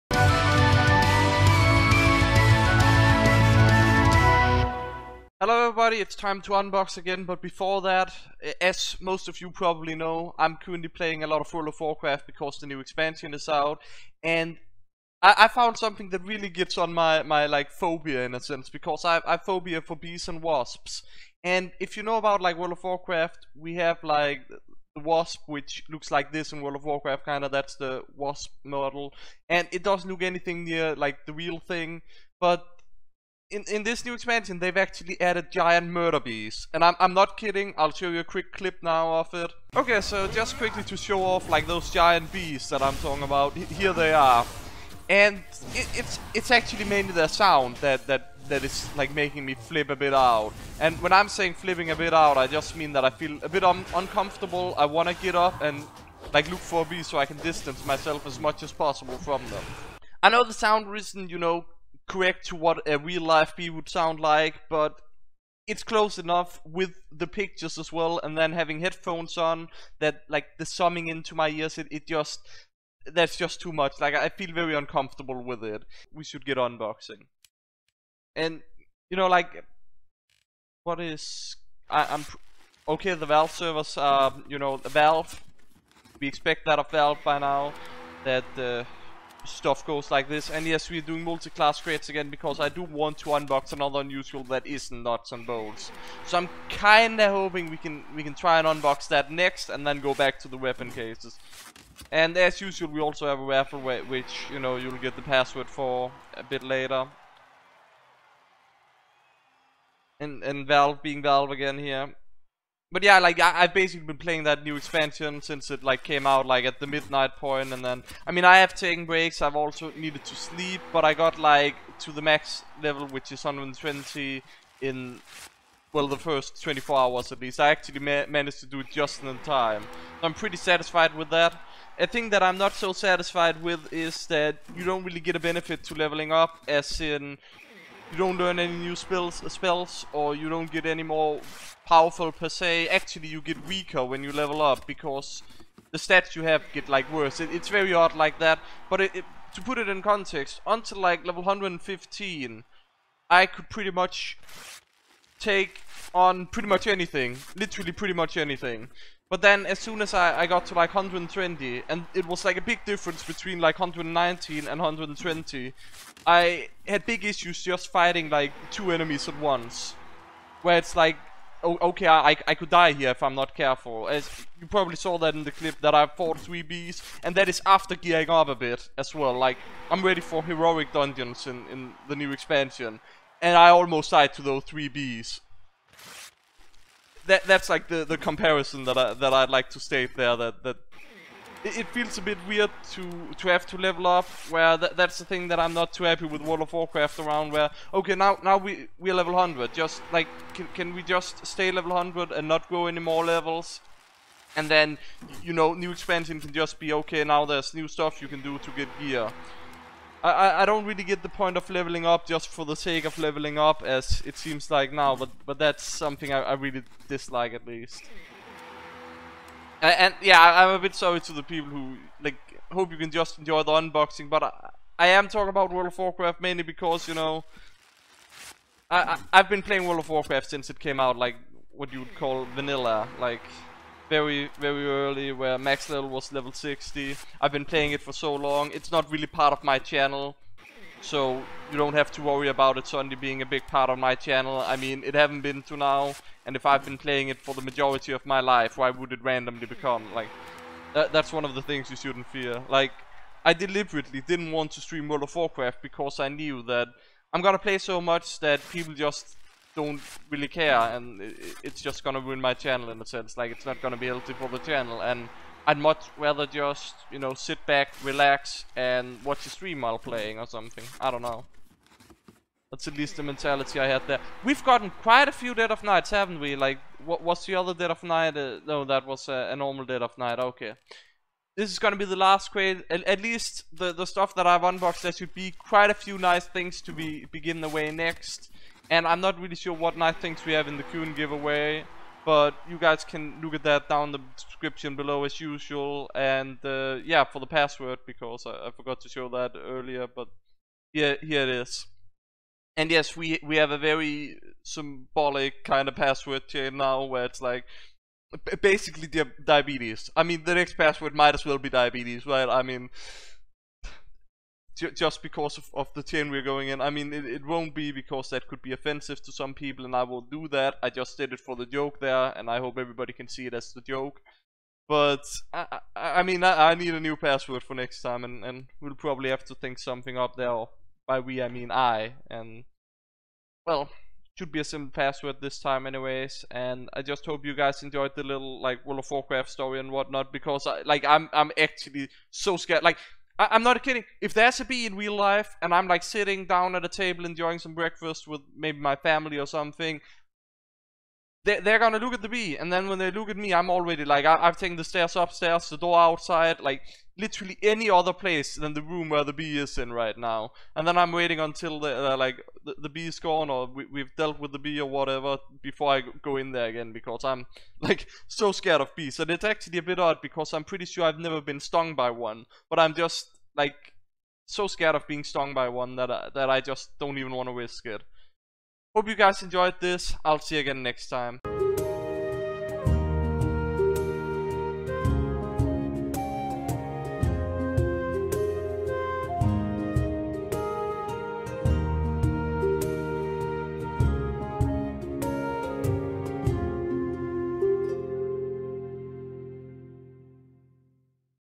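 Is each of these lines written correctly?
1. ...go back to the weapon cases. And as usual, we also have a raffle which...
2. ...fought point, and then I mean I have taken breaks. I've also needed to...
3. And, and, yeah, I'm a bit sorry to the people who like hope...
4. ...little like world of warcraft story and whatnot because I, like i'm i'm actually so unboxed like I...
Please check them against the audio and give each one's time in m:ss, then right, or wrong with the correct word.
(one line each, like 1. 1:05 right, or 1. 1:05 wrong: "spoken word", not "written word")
1. 1:39 right
2. 1:56 wrong: "midnight", not "fought"
3. 3:39 right
4. 5:38 wrong: "scared", not "unboxed".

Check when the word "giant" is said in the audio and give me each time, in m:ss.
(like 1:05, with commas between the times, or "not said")
0:35, 0:41.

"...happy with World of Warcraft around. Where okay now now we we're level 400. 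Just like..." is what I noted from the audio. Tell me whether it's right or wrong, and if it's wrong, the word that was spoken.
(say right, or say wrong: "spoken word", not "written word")
wrong: "100", not "400".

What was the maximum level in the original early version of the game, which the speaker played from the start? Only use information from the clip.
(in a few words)
60.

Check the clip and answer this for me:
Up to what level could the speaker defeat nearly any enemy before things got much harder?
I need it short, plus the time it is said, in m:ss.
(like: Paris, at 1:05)
115, at 2:31.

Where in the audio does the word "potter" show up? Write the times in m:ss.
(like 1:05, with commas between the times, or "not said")
not said.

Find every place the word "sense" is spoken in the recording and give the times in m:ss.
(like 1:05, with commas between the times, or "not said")
0:18, 4:23.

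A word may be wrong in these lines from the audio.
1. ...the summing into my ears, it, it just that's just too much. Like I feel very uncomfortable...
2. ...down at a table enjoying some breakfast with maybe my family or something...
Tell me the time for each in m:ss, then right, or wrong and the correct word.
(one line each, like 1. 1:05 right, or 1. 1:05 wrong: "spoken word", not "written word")
1. 1:10 right
2. 5:46 right.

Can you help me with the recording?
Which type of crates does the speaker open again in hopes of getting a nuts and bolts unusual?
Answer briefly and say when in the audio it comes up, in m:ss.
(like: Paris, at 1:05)
multi-class crates, at 1:31.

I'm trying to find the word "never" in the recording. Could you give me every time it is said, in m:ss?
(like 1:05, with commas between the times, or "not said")
6:11.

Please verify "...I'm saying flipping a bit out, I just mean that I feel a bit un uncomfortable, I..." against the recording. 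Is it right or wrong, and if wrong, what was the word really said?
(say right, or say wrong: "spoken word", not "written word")
right.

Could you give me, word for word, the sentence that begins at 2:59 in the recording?
Like, I'm ready for heroic dungeons in, in the new expansion.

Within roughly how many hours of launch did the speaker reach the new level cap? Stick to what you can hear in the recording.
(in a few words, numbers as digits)
24.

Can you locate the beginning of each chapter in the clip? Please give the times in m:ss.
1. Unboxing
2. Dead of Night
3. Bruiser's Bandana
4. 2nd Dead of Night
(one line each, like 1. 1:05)
1. 1:20
2. 2:03
3. 4:04
4. 4:27.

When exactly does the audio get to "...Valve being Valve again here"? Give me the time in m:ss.
1:50.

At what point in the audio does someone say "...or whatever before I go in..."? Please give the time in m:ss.
6:04.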